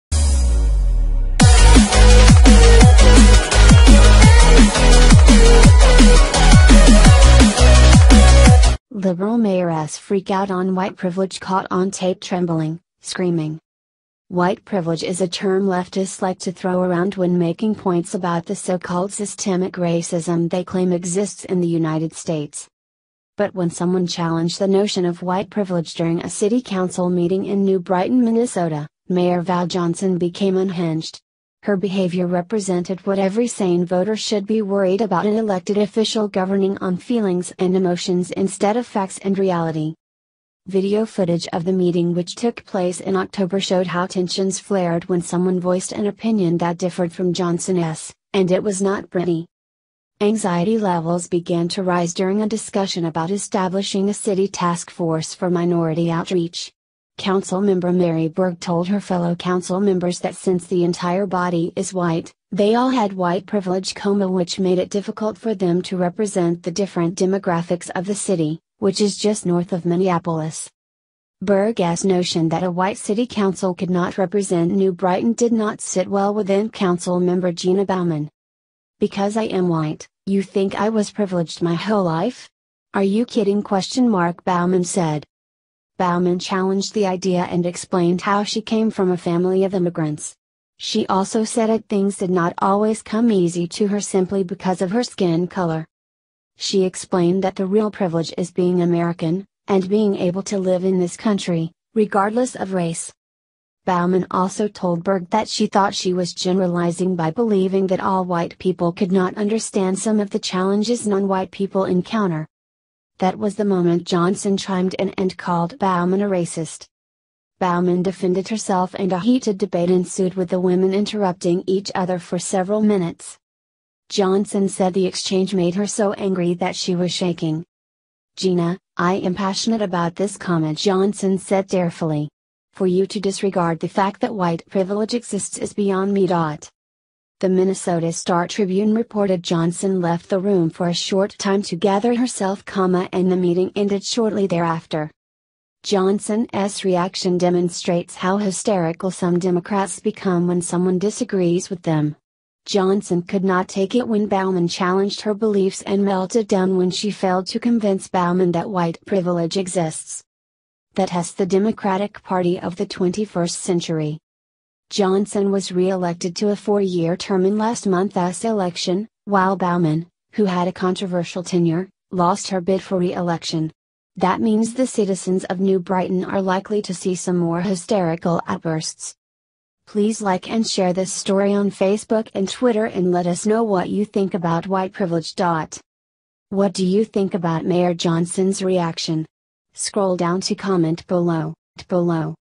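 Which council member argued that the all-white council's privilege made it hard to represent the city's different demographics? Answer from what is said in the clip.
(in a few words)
Mary Burg.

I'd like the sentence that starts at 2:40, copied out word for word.
That has the Democratic Party of the 21st century.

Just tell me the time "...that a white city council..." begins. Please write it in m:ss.
1:12.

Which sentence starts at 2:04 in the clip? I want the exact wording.
Johnson said the exchange made her so angry that she was shaking.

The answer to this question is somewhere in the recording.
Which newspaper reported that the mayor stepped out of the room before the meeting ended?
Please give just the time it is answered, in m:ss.
2:17.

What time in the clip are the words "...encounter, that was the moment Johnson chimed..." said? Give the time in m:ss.
1:51.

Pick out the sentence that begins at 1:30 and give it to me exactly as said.
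She also said that things did not always come easy to her simply because of her skin color.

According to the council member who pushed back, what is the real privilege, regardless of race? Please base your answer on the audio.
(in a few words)
Being American.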